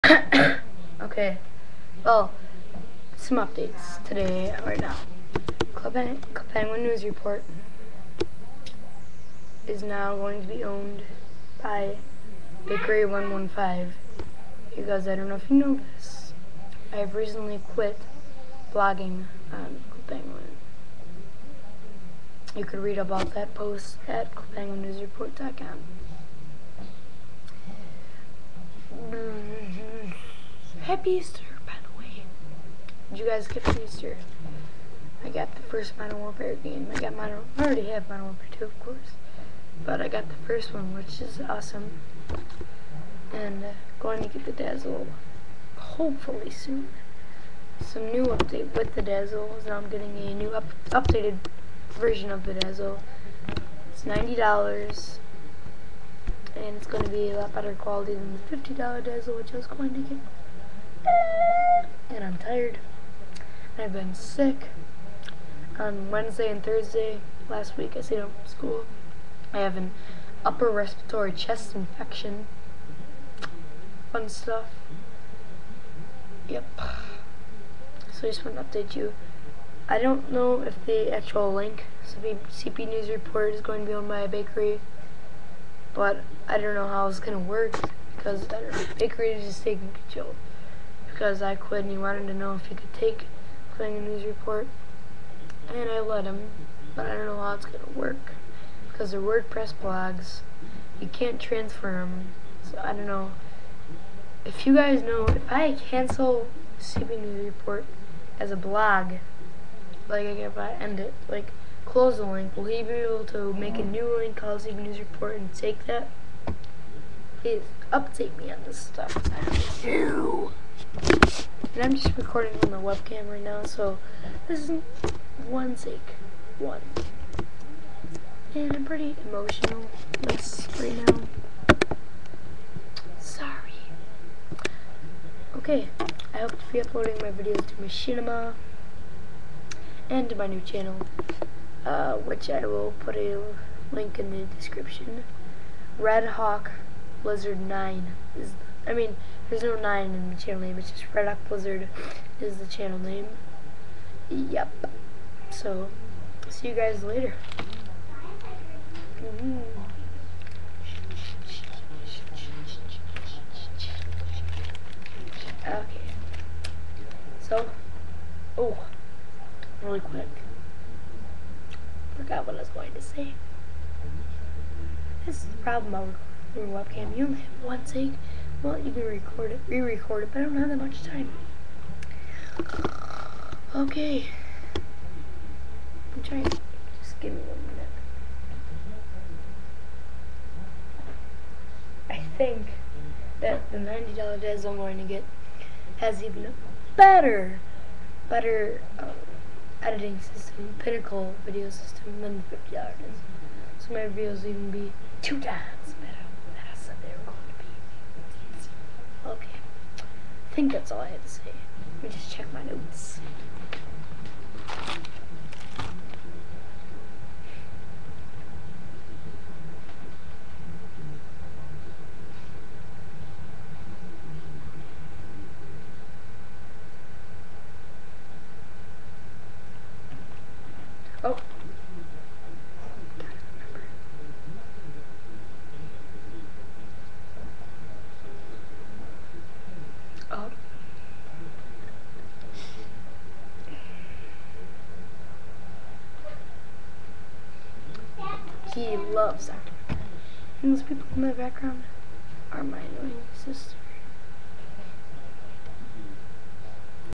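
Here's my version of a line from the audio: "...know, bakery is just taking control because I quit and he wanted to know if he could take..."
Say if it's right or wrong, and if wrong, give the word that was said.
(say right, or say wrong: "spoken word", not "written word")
right.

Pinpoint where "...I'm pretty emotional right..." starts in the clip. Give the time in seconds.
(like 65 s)
128 s.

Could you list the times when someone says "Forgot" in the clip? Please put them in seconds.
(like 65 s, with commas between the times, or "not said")
172 s.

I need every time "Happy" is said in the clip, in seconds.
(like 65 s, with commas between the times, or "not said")
30 s.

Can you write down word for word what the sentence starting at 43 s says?
And uh, going to get the Dazzle hopefully soon.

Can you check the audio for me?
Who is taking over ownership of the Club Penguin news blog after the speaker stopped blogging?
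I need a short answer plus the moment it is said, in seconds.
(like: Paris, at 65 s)
Bakery 115, at 12 s.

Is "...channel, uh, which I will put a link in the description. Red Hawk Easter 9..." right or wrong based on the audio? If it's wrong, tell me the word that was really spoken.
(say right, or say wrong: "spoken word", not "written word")
wrong: "Blizzard", not "Easter".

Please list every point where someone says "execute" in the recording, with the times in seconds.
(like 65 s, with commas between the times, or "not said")
not said.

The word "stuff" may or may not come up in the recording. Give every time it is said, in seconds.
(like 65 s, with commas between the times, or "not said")
74 s, 118 s.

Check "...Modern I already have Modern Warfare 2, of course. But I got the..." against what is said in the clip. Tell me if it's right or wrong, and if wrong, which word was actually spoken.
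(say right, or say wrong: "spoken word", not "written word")
right.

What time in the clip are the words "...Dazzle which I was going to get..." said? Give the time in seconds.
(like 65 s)
59 s.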